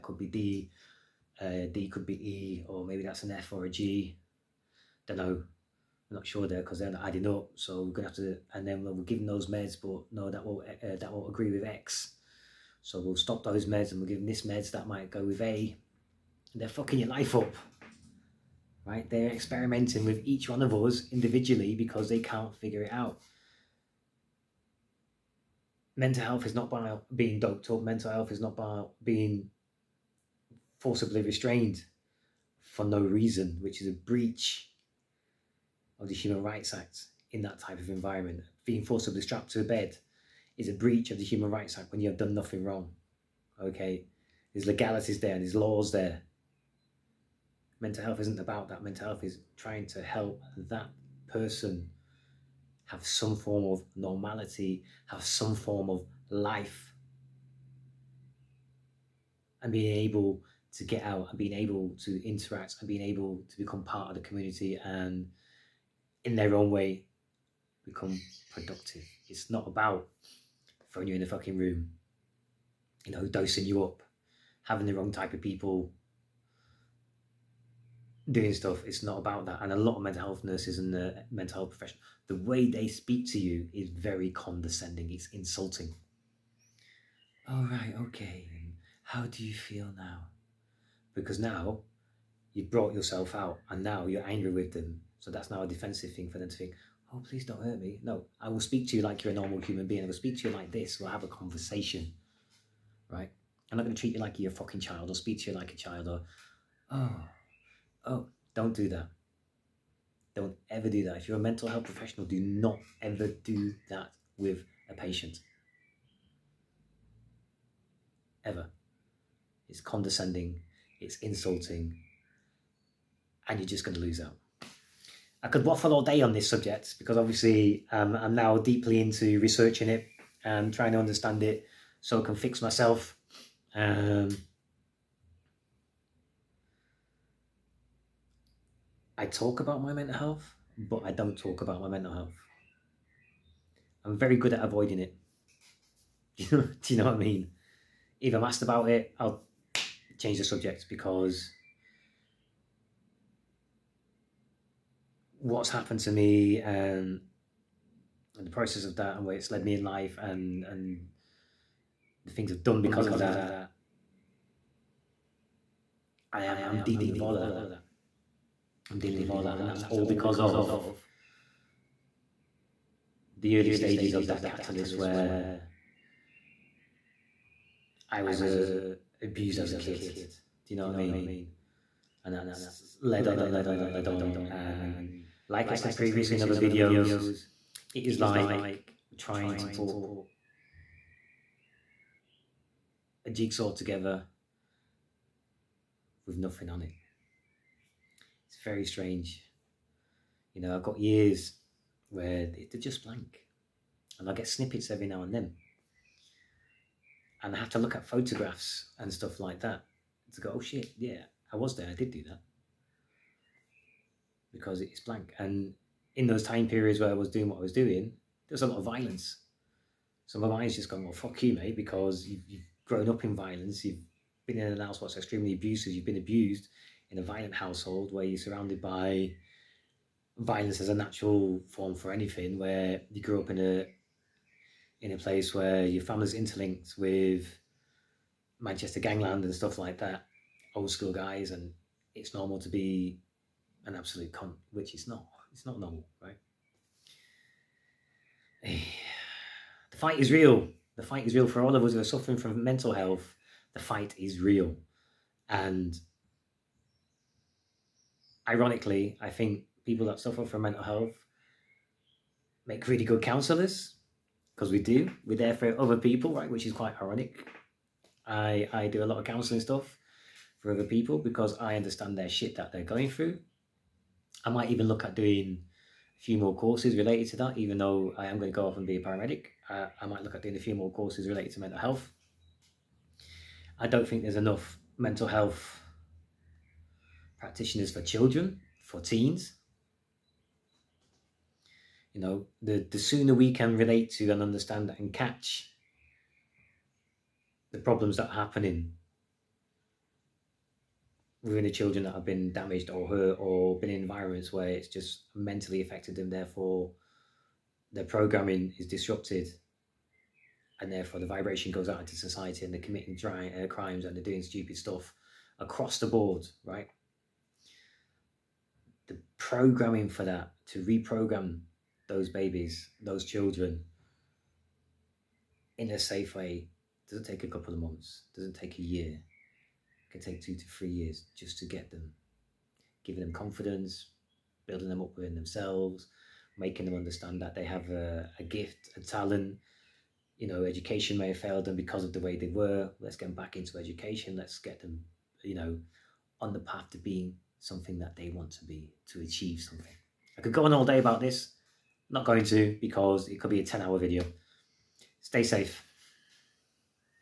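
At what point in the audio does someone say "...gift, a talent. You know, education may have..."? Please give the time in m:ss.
5:38.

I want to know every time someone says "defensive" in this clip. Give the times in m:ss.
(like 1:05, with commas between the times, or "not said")
1:35.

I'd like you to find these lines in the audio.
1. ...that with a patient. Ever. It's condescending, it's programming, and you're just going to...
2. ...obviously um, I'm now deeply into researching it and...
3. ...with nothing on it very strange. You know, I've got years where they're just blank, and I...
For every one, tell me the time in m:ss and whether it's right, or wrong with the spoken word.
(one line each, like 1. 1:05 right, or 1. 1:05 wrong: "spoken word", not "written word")
1. 1:53 wrong: "insulting", not "programming"
2. 2:07 right
3. 3:16 right.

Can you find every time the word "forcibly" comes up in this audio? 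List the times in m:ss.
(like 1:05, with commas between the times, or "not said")
0:30, 0:38.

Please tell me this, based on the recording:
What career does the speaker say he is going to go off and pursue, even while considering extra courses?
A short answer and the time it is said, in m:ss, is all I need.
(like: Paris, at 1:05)
Paramedic, at 4:39.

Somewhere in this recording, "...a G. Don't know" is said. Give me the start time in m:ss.
0:03.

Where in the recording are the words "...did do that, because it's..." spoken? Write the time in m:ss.
3:31.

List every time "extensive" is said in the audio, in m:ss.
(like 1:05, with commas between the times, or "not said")
not said.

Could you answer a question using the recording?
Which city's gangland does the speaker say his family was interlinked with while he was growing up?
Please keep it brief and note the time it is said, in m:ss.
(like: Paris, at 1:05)
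Manchester, at 3:58.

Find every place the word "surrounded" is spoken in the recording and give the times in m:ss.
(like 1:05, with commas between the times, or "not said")
3:48.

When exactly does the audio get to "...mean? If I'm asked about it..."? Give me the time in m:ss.
2:27.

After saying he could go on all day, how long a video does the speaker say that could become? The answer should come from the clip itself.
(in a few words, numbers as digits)
10 hours.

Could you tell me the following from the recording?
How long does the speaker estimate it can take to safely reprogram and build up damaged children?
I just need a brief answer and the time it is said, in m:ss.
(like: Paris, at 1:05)
2 to 3 years, at 5:30.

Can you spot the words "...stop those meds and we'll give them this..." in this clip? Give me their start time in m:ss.
0:13.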